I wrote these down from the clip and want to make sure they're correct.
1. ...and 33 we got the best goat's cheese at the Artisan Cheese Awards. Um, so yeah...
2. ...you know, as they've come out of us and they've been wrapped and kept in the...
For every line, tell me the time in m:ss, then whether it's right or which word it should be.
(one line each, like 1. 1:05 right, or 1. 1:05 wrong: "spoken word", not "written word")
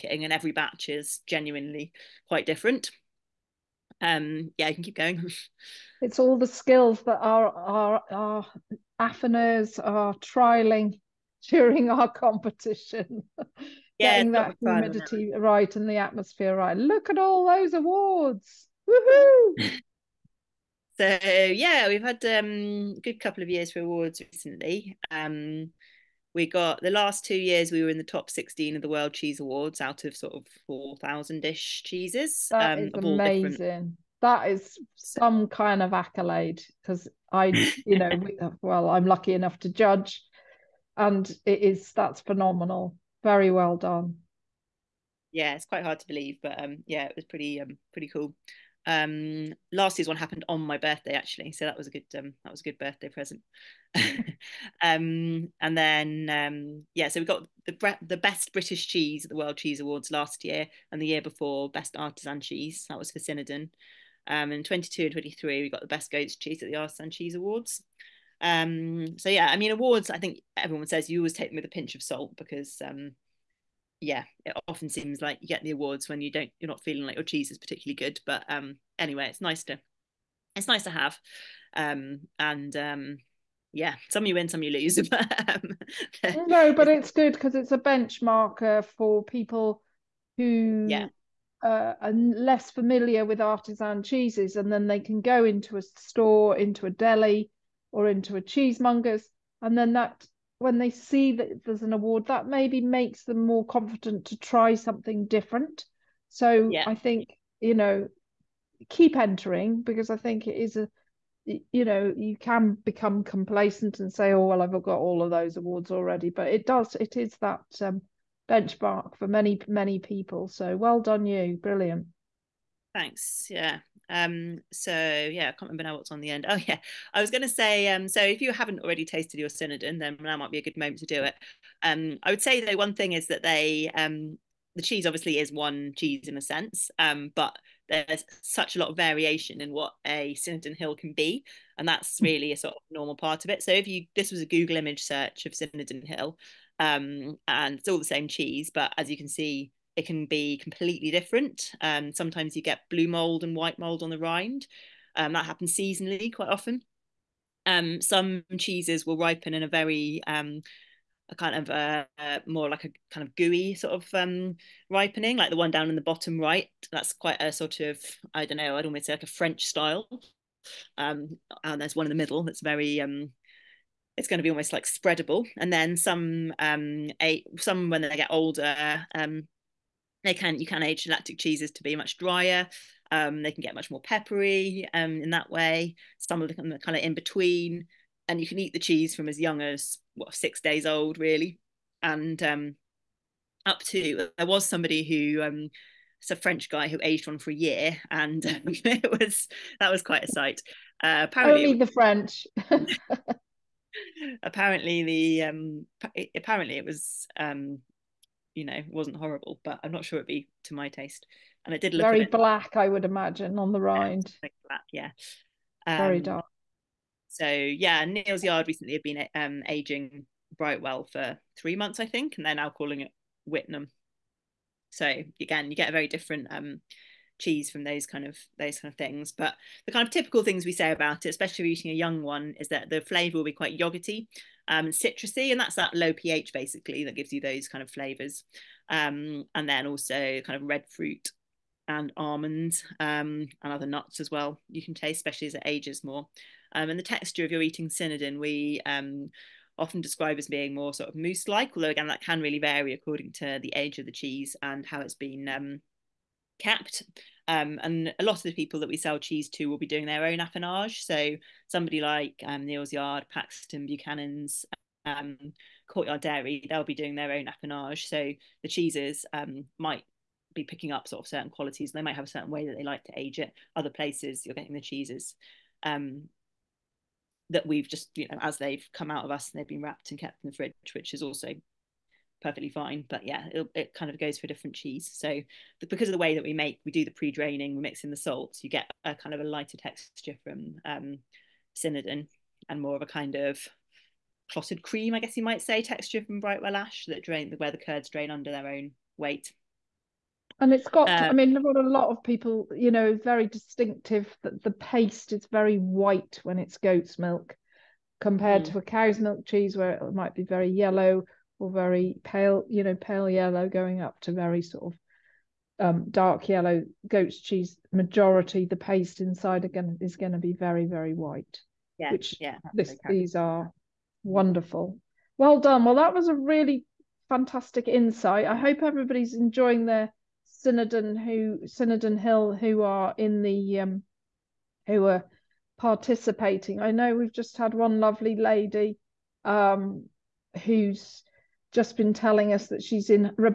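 1. 1:05 wrong: "23", not "33"
2. 4:38 right.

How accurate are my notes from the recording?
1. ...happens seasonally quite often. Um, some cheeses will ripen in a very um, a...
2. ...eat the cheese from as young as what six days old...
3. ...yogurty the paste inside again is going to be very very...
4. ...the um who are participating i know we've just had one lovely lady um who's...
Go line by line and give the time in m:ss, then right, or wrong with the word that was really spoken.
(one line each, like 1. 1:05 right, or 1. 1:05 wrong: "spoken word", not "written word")
1. 2:35 right
2. 3:08 right
3. 5:17 wrong: "majority", not "yogurty"
4. 5:33 right.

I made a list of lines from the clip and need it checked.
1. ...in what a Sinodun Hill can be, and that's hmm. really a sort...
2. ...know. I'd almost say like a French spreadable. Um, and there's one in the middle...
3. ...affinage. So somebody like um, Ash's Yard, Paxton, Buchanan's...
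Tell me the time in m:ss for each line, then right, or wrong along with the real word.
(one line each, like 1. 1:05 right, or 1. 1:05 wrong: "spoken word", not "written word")
1. 2:19 right
2. 2:48 wrong: "style", not "spreadable"
3. 4:20 wrong: "Neal", not "Ash".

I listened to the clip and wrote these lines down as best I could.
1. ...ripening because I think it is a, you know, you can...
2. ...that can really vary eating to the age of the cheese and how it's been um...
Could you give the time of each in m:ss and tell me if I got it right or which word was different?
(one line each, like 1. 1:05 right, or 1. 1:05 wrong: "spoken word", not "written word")
1. 1:49 wrong: "entering", not "ripening"
2. 4:12 wrong: "according", not "eating".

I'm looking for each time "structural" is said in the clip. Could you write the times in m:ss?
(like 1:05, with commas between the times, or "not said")
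not said.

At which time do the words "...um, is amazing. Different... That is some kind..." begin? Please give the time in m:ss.
0:32.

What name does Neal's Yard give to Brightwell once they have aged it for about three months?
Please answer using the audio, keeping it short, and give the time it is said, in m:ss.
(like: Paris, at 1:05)
Whitnam, at 3:43.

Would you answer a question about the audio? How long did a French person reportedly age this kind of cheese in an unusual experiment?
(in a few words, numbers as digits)
A year.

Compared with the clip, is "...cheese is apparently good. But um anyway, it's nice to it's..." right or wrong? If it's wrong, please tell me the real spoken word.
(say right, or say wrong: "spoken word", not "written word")
wrong: "particularly", not "apparently".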